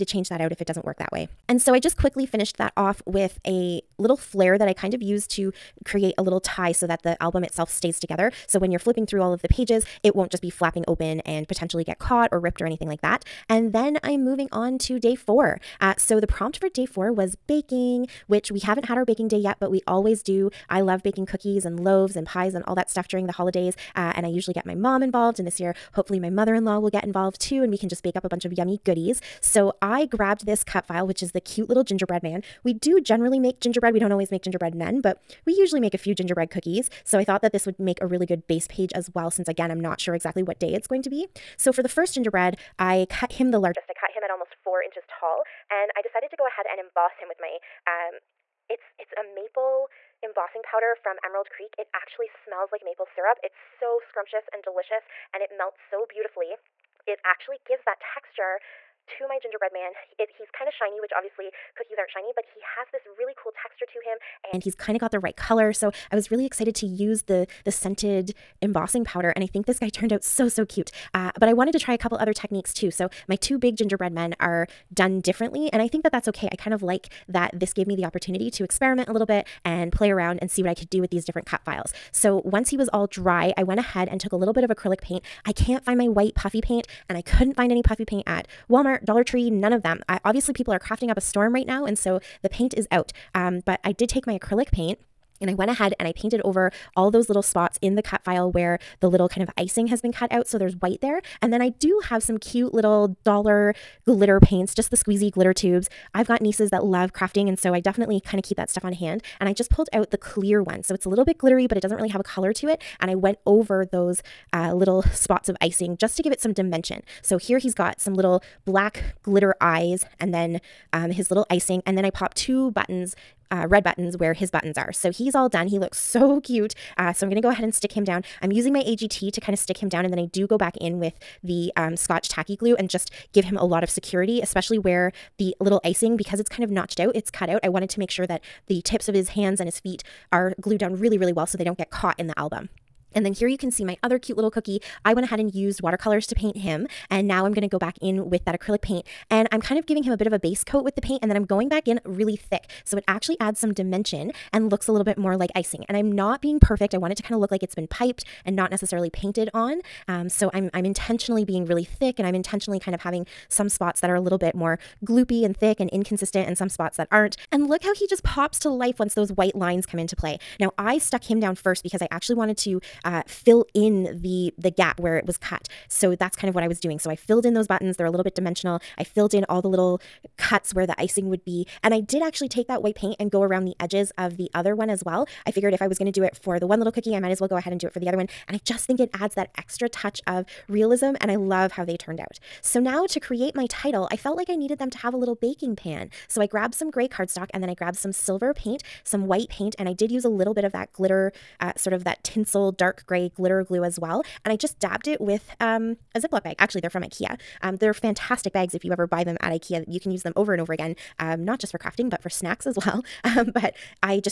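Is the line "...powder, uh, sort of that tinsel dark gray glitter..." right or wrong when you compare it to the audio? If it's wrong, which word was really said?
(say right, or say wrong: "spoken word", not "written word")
wrong: "glitter", not "powder".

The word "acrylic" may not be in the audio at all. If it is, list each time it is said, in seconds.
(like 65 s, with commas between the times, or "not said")
84 s, 94 s, 148 s.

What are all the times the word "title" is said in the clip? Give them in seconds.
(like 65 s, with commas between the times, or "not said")
193 s.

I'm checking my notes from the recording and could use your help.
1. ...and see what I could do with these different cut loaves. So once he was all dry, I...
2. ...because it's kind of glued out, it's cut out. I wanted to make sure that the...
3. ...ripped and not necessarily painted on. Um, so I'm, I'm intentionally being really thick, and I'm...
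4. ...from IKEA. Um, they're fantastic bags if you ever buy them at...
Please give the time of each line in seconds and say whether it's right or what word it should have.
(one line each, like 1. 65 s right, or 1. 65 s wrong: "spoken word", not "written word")
1. 80 s wrong: "files", not "loaves"
2. 136 s wrong: "notched", not "glued"
3. 157 s wrong: "piped", not "ripped"
4. 206 s right.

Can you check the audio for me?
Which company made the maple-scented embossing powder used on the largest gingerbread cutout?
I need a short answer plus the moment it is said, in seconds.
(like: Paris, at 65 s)
Emerald Creek, at 51 s.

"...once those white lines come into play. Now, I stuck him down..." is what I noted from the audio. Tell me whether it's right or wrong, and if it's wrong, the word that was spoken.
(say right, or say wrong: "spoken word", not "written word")
right.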